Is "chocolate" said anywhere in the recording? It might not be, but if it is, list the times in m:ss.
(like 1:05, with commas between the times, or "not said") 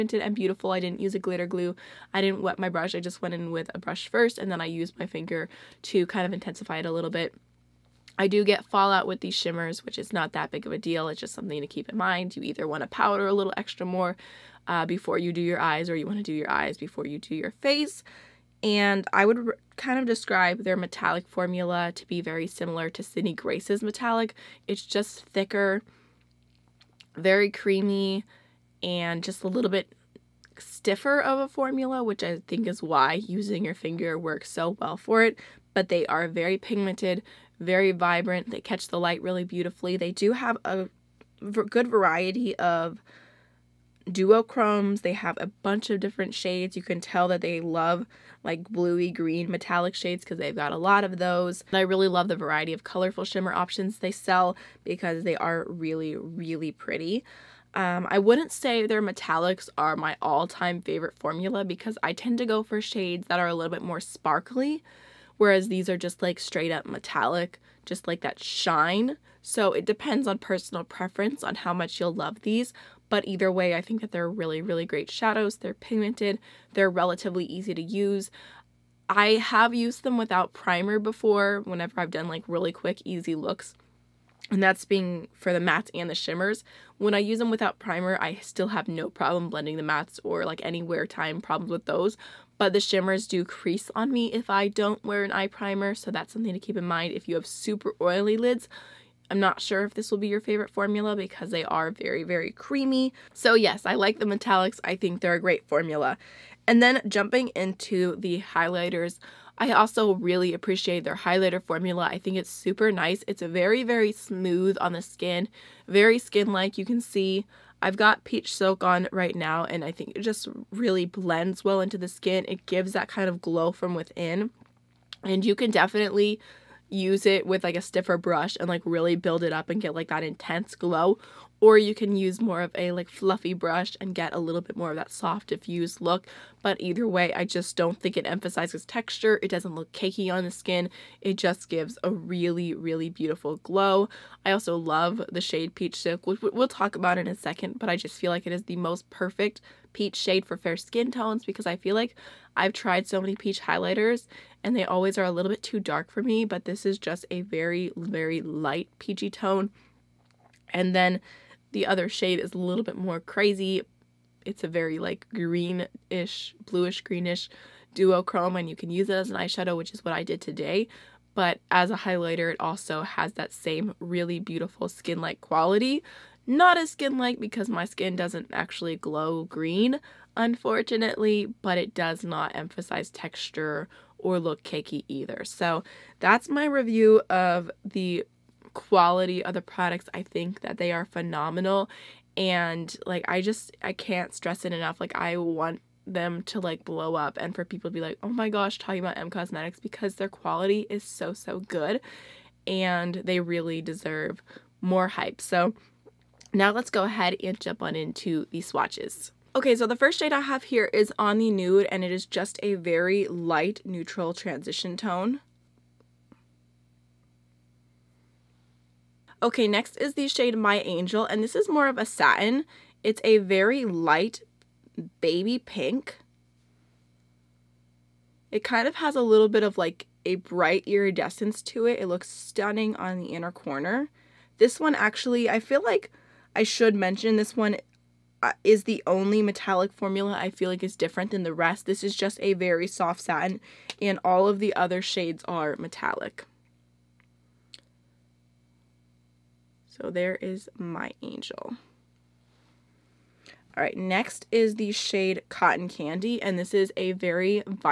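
not said.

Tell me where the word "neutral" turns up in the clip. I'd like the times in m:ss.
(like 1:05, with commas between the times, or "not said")
3:33.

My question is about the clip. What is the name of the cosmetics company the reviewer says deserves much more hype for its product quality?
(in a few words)
Emme Cosmetics.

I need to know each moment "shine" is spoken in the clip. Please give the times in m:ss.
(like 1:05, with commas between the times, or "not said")
1:08.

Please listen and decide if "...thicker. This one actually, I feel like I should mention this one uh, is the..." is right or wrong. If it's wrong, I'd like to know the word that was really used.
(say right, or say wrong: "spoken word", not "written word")
wrong: "corner", not "thicker".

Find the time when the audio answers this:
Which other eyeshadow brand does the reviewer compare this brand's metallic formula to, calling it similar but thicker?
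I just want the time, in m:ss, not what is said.
0:23.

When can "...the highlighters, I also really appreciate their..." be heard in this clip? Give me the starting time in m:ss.
1:48.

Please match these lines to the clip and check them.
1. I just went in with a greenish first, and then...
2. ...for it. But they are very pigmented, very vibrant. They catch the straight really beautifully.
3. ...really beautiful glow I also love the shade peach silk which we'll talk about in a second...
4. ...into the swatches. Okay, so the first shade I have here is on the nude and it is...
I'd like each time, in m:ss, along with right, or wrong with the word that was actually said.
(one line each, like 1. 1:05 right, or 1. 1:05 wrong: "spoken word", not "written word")
1. 0:02 wrong: "brush", not "greenish"
2. 0:34 wrong: "light", not "straight"
3. 2:22 right
4. 3:27 right.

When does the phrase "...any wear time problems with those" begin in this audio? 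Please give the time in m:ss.
1:30.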